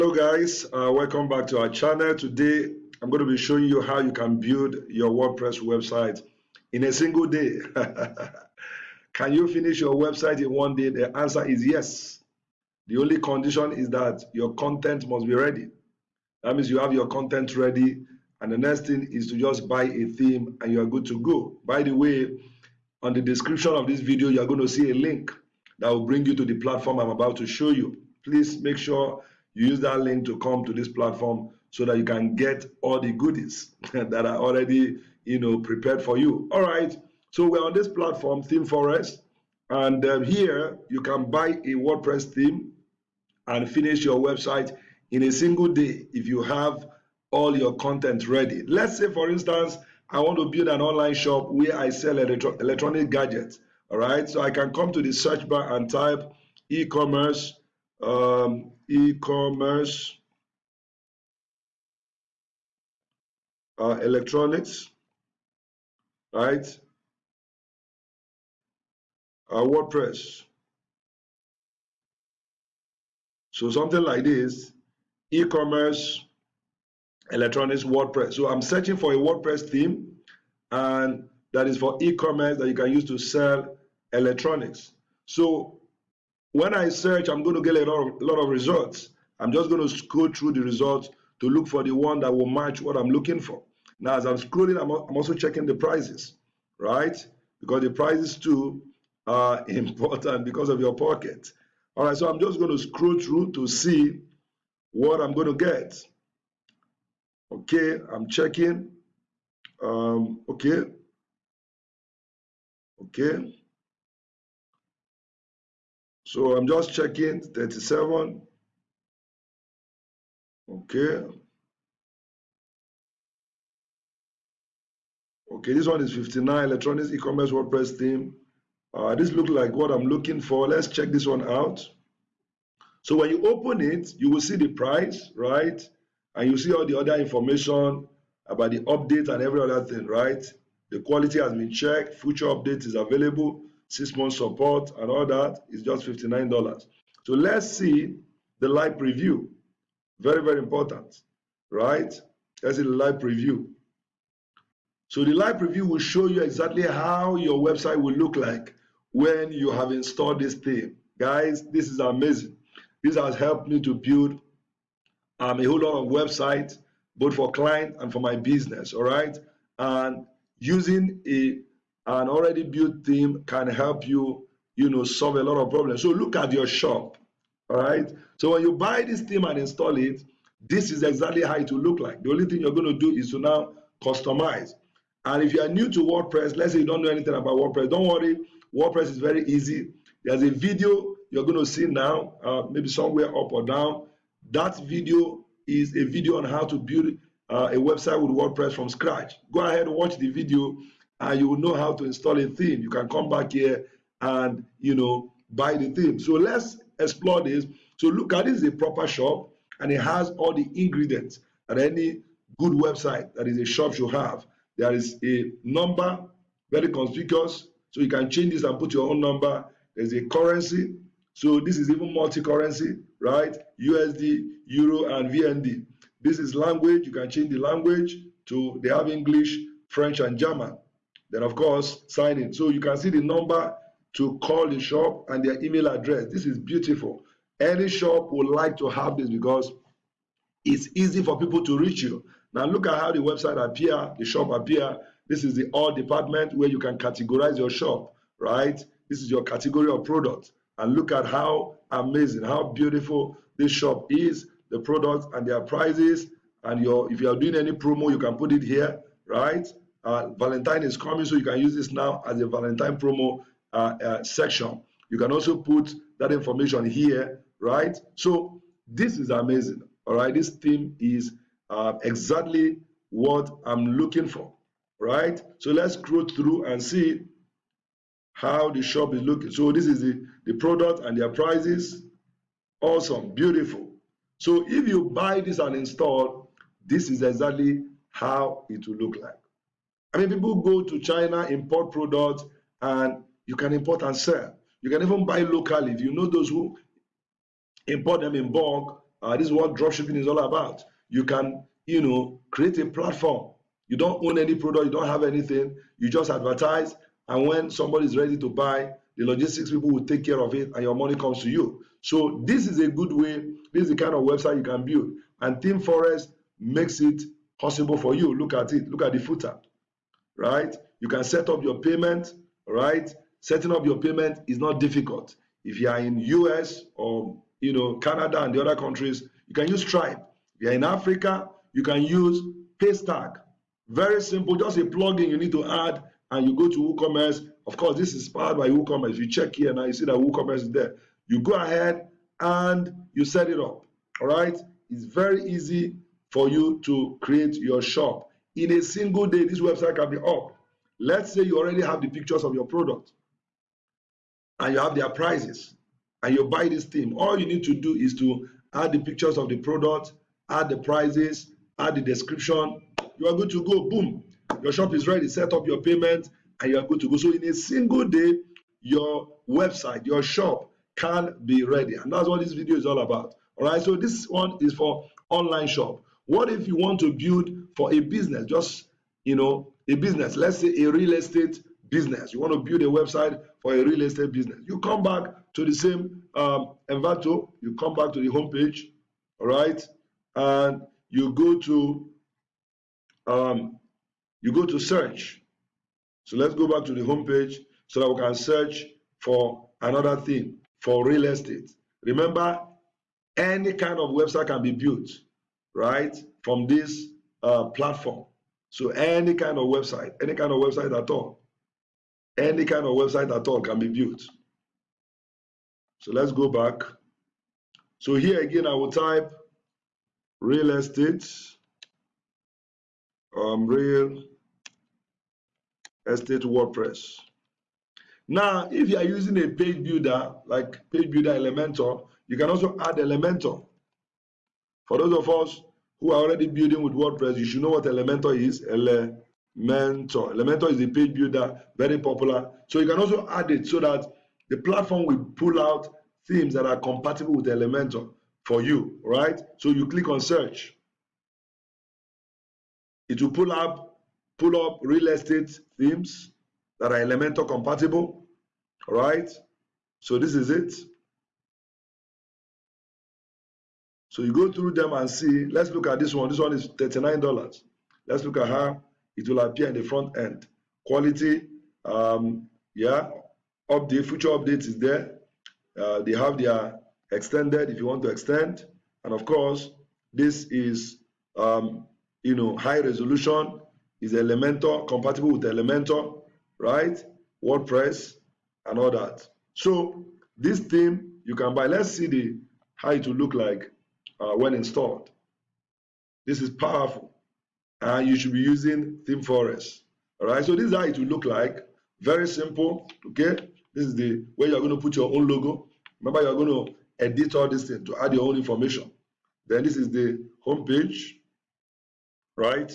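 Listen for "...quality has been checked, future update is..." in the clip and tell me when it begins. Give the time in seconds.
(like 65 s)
140 s.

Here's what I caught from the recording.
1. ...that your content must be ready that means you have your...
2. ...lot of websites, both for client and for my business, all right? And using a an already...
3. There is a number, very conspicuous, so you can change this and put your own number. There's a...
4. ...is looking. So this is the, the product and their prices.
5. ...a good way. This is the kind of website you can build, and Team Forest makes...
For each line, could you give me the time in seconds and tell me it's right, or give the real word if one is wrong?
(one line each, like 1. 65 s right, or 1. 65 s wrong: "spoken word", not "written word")
1. 13 s right
2. 165 s right
3. 214 s right
4. 279 s right
5. 312 s right.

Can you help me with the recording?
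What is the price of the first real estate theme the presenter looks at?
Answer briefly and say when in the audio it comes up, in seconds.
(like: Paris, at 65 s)
$39, at 466 s.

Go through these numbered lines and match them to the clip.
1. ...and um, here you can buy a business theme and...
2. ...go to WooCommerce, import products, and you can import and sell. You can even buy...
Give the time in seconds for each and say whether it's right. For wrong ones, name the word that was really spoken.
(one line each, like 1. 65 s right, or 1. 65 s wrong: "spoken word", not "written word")
1. 39 s wrong: "wordpress", not "business"
2. 290 s wrong: "China", not "WooCommerce".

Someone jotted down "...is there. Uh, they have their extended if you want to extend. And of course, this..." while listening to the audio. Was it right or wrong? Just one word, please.
right.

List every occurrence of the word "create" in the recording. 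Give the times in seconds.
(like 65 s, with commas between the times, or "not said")
302 s, 347 s.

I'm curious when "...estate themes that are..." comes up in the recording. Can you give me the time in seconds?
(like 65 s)
455 s.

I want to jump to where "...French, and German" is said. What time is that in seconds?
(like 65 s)
229 s.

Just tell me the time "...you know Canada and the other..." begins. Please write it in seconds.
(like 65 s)
327 s.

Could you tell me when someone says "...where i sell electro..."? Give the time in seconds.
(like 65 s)
51 s.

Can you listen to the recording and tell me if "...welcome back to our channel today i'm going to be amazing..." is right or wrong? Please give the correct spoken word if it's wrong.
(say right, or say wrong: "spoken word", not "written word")
wrong: "showing", not "amazing".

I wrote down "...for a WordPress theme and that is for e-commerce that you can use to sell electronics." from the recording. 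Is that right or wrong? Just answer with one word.
right.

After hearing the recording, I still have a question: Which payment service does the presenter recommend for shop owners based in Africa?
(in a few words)
Paystack.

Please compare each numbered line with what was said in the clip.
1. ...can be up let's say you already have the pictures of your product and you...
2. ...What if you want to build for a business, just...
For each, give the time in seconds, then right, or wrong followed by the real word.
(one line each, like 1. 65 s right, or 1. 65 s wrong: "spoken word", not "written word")
1. 349 s right
2. 376 s right.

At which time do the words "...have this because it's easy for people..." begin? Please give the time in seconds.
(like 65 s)
238 s.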